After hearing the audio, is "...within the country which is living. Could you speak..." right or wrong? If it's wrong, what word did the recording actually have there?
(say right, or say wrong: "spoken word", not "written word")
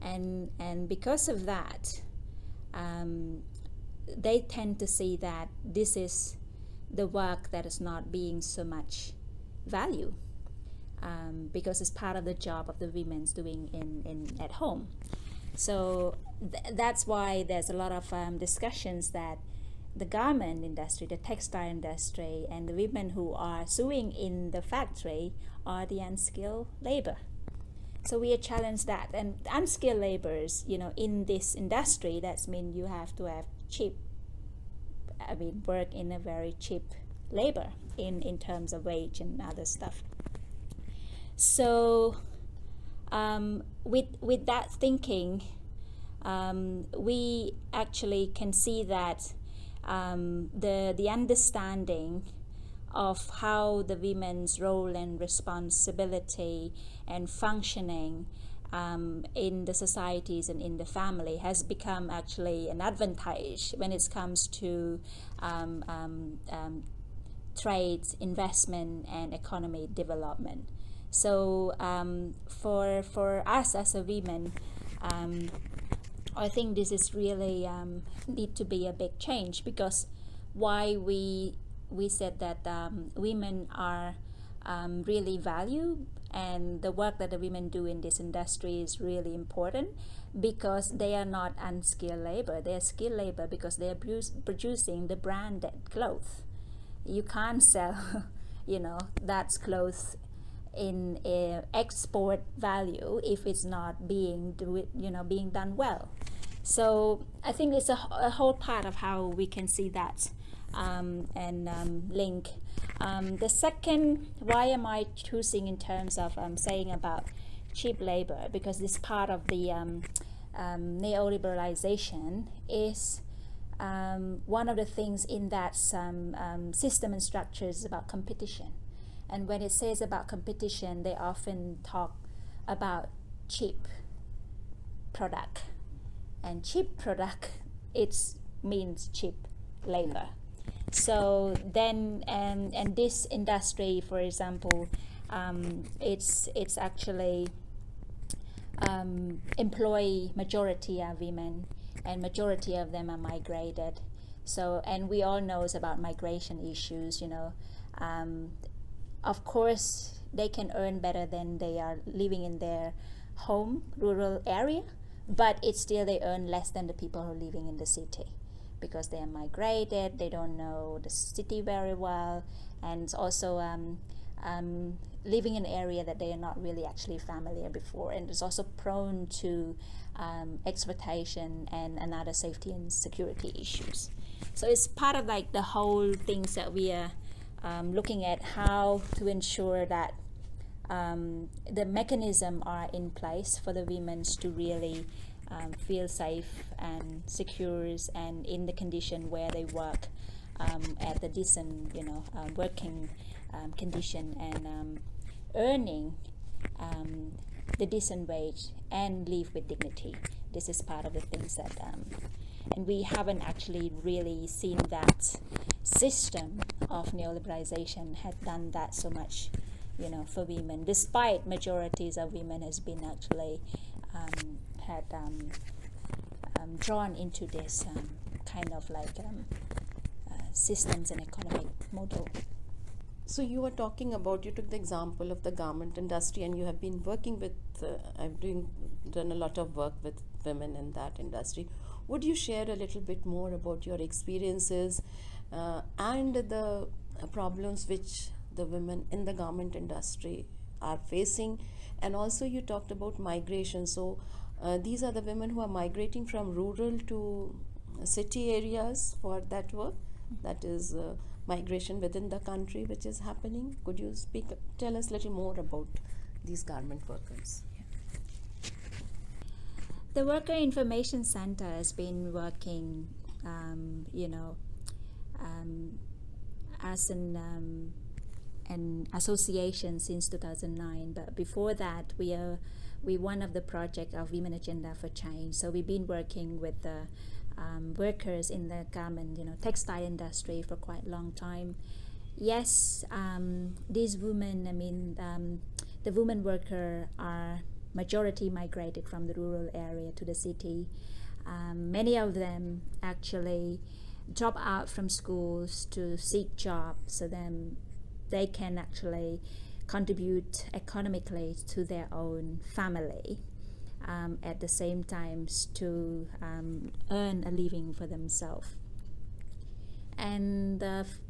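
wrong: "happening", not "living".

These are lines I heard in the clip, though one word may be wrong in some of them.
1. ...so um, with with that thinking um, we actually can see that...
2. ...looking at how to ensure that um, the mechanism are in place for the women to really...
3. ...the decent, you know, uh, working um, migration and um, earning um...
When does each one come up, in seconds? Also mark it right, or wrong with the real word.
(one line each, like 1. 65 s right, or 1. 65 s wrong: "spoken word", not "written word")
1. 41 s right
2. 187 s right
3. 201 s wrong: "condition", not "migration".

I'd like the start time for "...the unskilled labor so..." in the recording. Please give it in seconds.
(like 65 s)
25 s.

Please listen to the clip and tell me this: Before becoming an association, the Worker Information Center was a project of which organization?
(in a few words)
Women Agenda for Change.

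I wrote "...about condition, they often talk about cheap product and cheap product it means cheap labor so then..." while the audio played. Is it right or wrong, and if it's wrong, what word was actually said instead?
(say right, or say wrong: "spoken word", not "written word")
wrong: "competition", not "condition".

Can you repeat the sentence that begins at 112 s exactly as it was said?
Um, the second, why am I choosing in terms of um, saying about cheap labor?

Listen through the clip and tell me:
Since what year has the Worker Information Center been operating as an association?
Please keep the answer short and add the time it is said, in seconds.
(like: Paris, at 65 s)
2009, at 280 s.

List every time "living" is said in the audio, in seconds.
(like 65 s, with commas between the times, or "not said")
162 s, 167 s, 175 s, 317 s.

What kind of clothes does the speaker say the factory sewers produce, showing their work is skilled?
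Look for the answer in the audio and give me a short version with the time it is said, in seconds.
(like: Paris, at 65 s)
Branded clothes, at 95 s.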